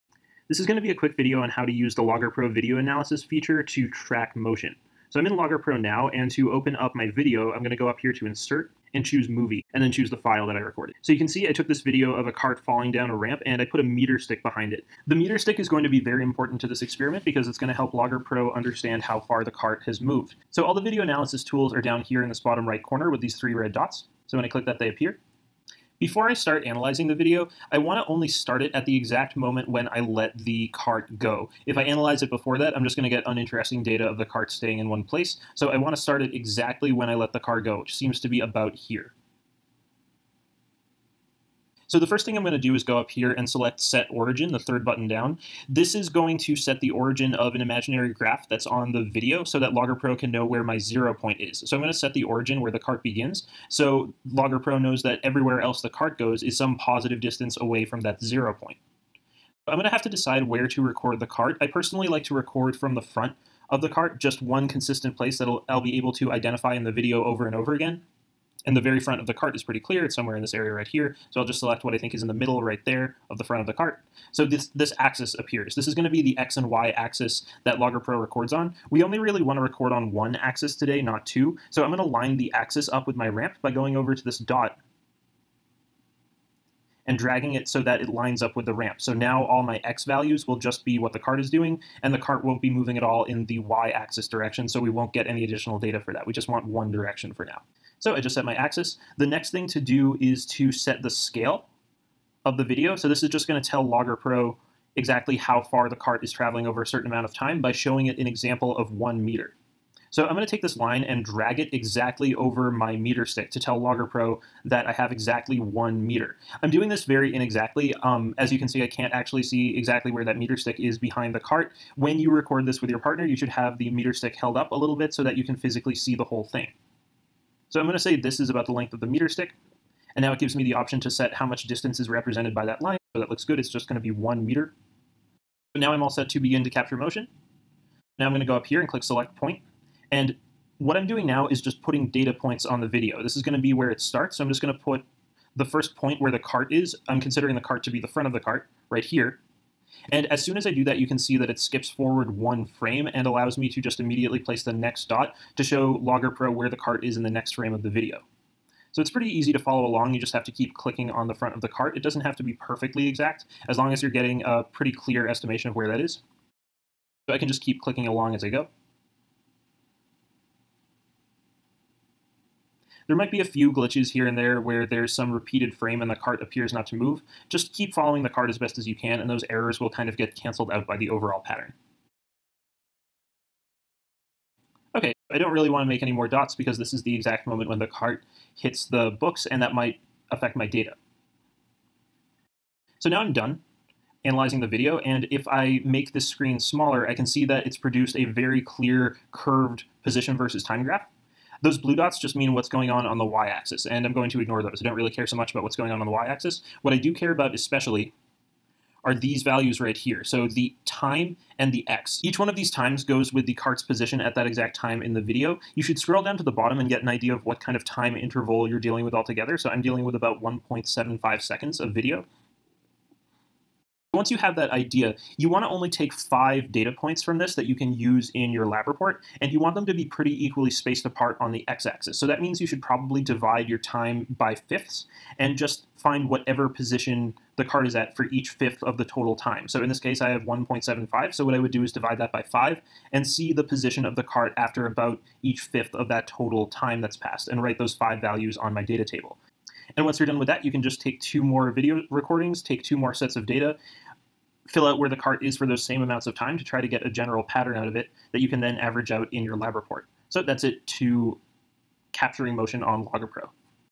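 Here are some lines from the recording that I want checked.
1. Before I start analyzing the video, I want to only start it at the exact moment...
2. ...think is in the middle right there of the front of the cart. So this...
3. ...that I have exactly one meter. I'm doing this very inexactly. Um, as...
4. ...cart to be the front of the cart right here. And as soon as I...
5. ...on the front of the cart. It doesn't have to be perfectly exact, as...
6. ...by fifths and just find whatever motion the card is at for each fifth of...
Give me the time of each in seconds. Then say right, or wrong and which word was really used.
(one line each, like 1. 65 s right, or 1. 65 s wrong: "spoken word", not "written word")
1. 26 s right
2. 71 s right
3. 114 s right
4. 147 s right
5. 161 s right
6. 234 s wrong: "position", not "motion".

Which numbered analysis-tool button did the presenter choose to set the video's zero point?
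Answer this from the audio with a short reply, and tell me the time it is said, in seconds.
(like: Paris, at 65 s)
third, at 44 s.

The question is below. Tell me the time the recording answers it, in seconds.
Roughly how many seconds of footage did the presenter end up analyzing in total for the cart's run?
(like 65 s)
220 s.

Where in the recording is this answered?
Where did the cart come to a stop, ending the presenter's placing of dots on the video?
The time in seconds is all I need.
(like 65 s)
188 s.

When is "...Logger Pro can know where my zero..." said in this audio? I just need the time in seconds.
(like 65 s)
49 s.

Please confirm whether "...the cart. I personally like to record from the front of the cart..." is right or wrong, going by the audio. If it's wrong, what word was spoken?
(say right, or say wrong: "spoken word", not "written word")
right.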